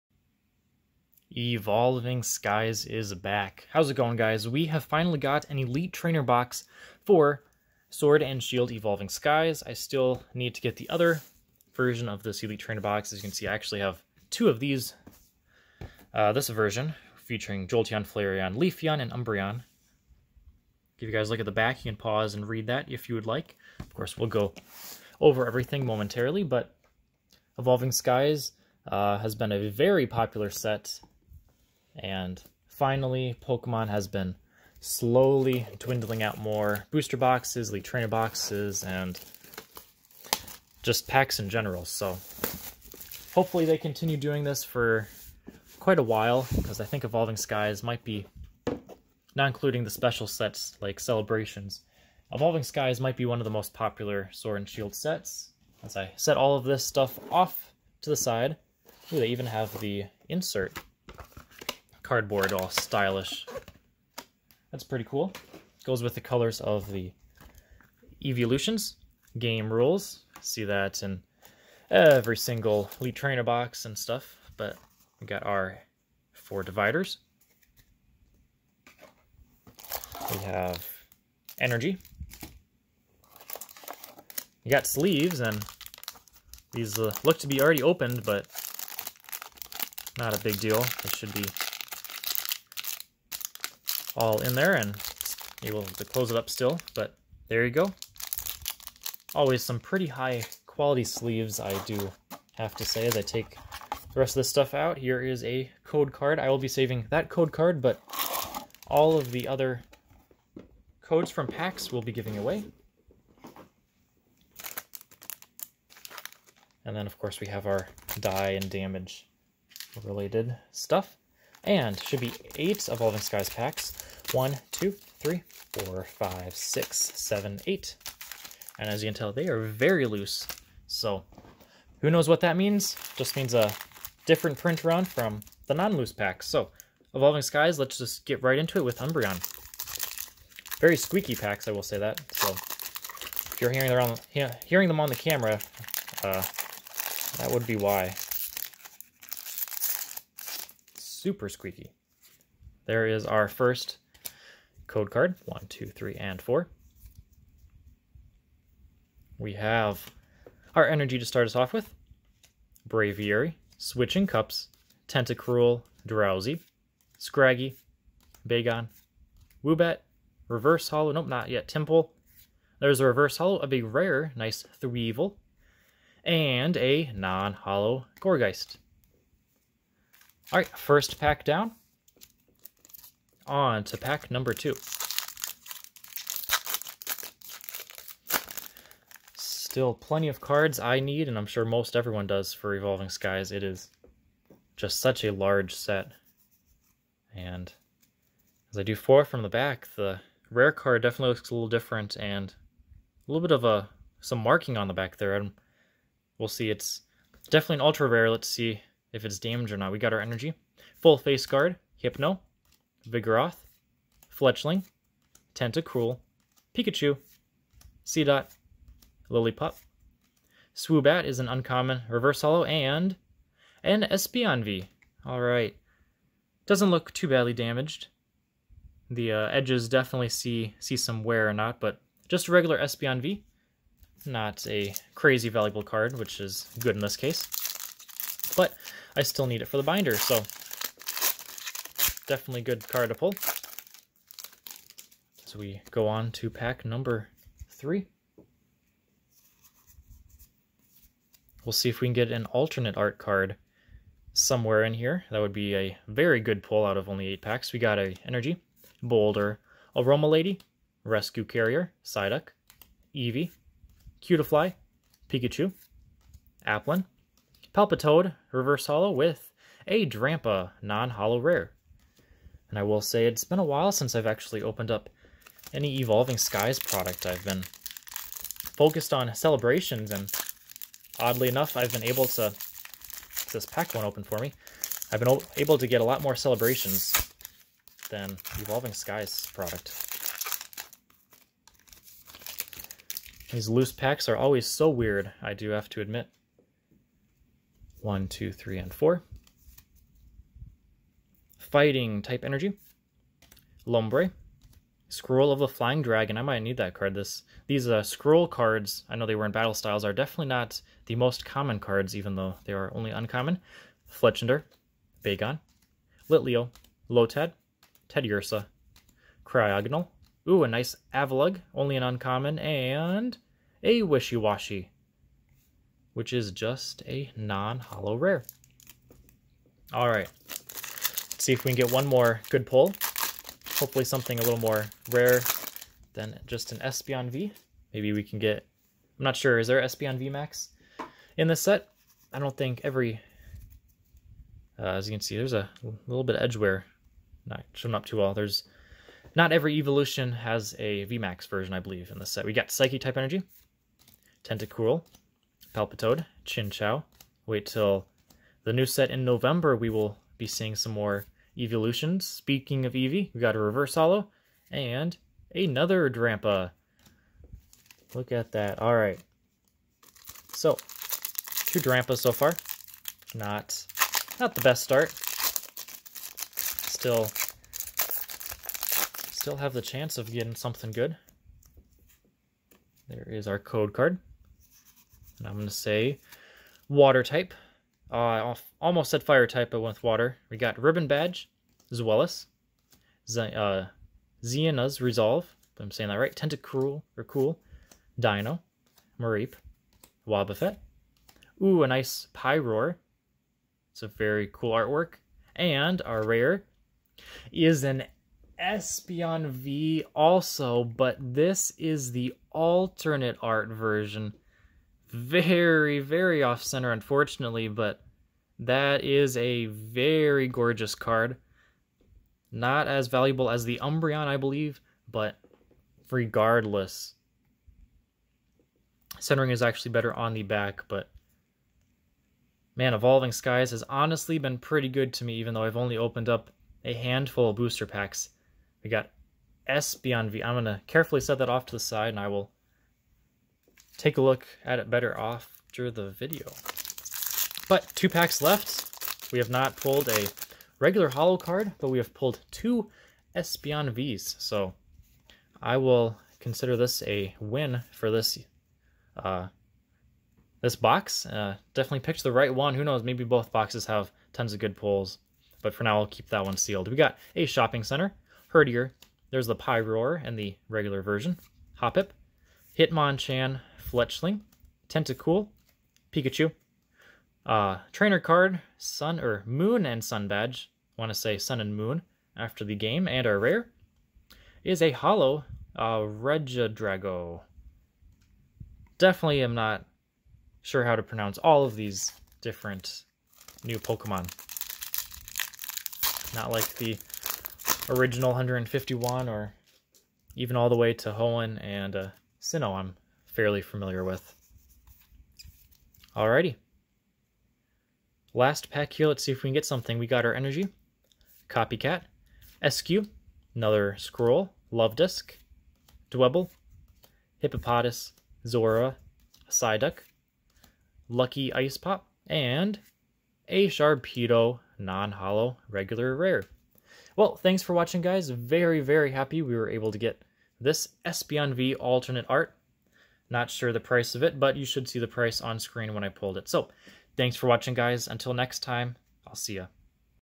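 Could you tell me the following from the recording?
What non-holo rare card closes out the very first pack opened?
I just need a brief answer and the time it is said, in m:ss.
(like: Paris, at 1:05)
Gourgeist, at 2:58.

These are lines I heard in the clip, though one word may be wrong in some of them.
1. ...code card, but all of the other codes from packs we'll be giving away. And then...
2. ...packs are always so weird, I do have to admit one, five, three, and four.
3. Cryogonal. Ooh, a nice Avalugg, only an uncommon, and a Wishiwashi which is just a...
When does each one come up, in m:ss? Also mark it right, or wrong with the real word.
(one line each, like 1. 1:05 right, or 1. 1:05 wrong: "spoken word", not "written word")
1. 1:47 right
2. 4:53 wrong: "two", not "five"
3. 5:19 right.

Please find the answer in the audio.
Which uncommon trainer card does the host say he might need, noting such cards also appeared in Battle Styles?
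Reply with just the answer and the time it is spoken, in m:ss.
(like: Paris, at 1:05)
Scroll of the Flying Dragon, at 5:05.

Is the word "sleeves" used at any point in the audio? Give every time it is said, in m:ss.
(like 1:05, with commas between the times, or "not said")
1:24, 1:41.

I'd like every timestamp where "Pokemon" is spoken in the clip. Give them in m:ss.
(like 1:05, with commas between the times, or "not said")
0:33, 8:13.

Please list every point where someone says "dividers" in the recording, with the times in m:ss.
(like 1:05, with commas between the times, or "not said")
1:16.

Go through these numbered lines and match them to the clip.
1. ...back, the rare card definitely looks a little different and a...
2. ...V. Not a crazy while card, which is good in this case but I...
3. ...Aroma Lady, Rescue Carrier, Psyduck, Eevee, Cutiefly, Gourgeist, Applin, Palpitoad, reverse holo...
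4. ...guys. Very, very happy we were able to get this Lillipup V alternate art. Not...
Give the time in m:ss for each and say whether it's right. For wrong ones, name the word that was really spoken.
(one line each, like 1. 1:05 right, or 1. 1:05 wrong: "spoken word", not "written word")
1. 3:19 right
2. 3:53 wrong: "valuable", not "while"
3. 4:19 wrong: "Pikachu", not "Gourgeist"
4. 8:48 wrong: "Espeon", not "Lillipup".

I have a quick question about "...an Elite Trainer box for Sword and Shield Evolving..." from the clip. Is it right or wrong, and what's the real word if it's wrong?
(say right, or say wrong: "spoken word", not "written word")
right.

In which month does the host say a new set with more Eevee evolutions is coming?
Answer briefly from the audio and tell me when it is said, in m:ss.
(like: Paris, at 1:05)
November, at 5:59.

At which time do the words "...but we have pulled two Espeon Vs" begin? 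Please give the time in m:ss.
7:31.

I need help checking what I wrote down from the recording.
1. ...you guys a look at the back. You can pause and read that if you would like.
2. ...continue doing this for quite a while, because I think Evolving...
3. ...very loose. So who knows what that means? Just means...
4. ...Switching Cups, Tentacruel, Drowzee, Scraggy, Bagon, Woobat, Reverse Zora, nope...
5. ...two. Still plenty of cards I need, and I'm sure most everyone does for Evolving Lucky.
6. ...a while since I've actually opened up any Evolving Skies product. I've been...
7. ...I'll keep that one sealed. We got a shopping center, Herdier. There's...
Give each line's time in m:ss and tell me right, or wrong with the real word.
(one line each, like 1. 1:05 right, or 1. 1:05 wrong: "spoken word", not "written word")
1. 0:21 right
2. 0:43 right
3. 2:09 right
4. 2:43 wrong: "Holo", not "Zora"
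5. 3:04 wrong: "Skies", not "Lucky"
6. 4:33 right
7. 7:45 right.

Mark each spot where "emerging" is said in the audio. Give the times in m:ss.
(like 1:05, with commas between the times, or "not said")
not said.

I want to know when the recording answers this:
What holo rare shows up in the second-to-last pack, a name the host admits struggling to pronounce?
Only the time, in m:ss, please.
8:05.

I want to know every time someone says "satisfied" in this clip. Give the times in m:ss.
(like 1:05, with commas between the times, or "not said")
not said.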